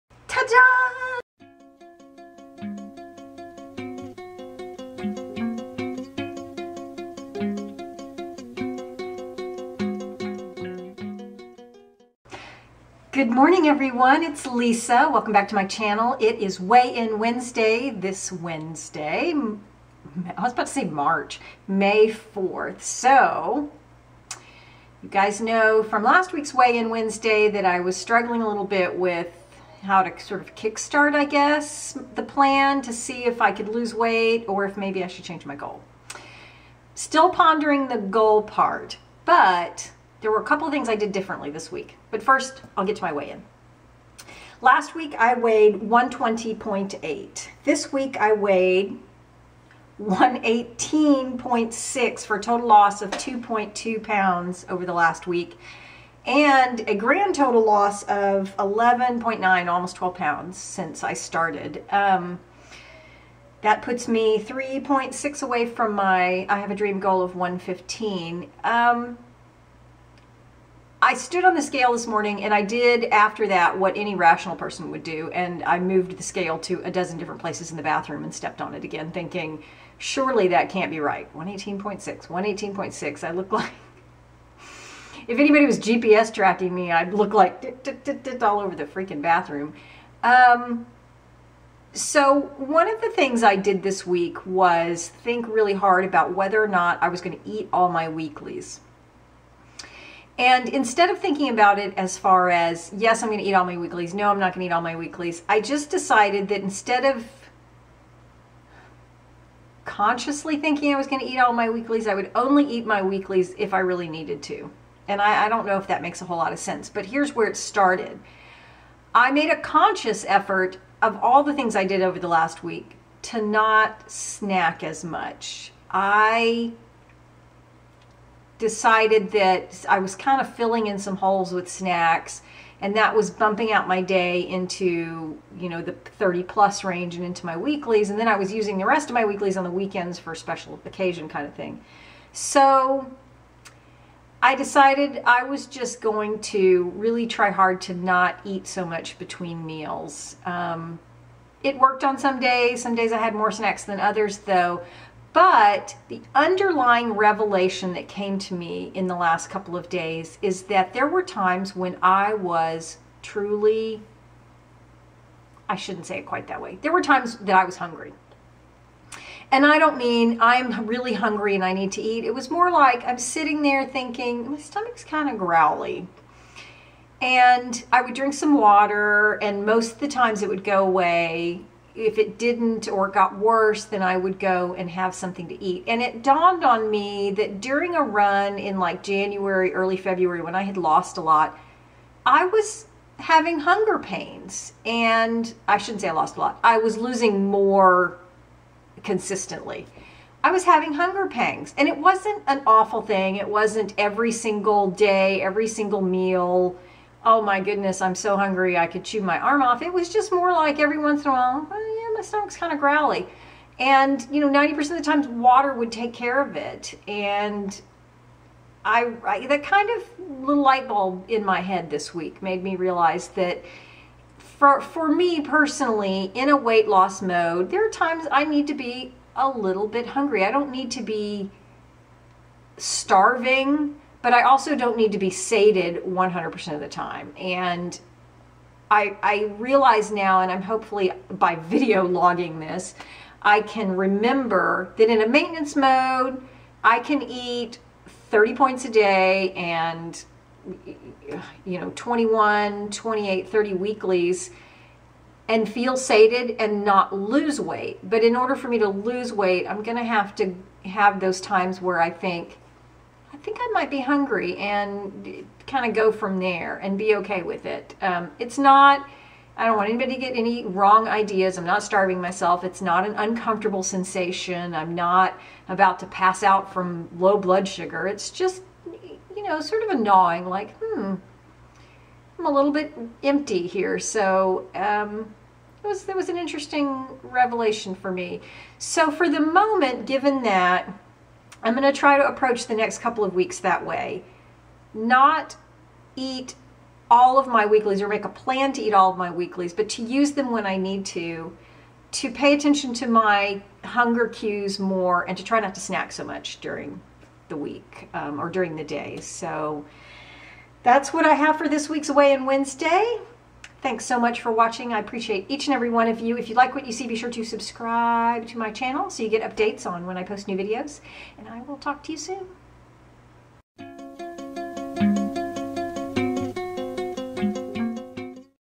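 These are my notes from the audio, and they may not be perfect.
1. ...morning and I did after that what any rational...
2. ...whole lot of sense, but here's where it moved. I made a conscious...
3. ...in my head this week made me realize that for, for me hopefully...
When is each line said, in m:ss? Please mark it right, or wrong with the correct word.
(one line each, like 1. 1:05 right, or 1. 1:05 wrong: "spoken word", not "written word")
1. 1:12 right
2. 1:56 wrong: "started", not "moved"
3. 3:41 wrong: "personally", not "hopefully".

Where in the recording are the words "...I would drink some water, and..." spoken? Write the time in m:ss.
2:57.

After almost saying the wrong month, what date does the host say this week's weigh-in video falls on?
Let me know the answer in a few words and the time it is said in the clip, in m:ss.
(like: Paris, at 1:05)
May 4th, at 0:21.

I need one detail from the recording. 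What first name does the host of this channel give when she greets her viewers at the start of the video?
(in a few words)
Lisa.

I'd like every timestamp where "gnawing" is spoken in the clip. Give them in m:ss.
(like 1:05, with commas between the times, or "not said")
4:39.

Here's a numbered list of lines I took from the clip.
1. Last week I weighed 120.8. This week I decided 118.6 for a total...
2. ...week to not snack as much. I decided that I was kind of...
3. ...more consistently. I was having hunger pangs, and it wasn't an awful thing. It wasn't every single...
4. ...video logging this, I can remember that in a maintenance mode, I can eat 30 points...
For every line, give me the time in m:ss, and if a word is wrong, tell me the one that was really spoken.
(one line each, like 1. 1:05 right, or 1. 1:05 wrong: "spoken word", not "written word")
1. 0:44 wrong: "weighed", not "decided"
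2. 2:02 right
3. 3:17 right
4. 4:01 right.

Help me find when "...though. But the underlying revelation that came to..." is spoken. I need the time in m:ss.
2:34.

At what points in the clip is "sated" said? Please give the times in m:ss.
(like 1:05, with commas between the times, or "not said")
3:55, 4:15.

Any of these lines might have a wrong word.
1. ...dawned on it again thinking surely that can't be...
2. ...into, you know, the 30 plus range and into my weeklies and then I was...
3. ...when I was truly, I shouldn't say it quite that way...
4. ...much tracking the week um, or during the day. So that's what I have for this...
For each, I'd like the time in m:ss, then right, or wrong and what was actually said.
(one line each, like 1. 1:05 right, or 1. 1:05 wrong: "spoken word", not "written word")
1. 1:18 wrong: "stepped", not "dawned"
2. 2:14 right
3. 2:41 right
4. 5:06 wrong: "during", not "tracking".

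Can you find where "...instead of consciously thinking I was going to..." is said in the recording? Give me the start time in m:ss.
1:46.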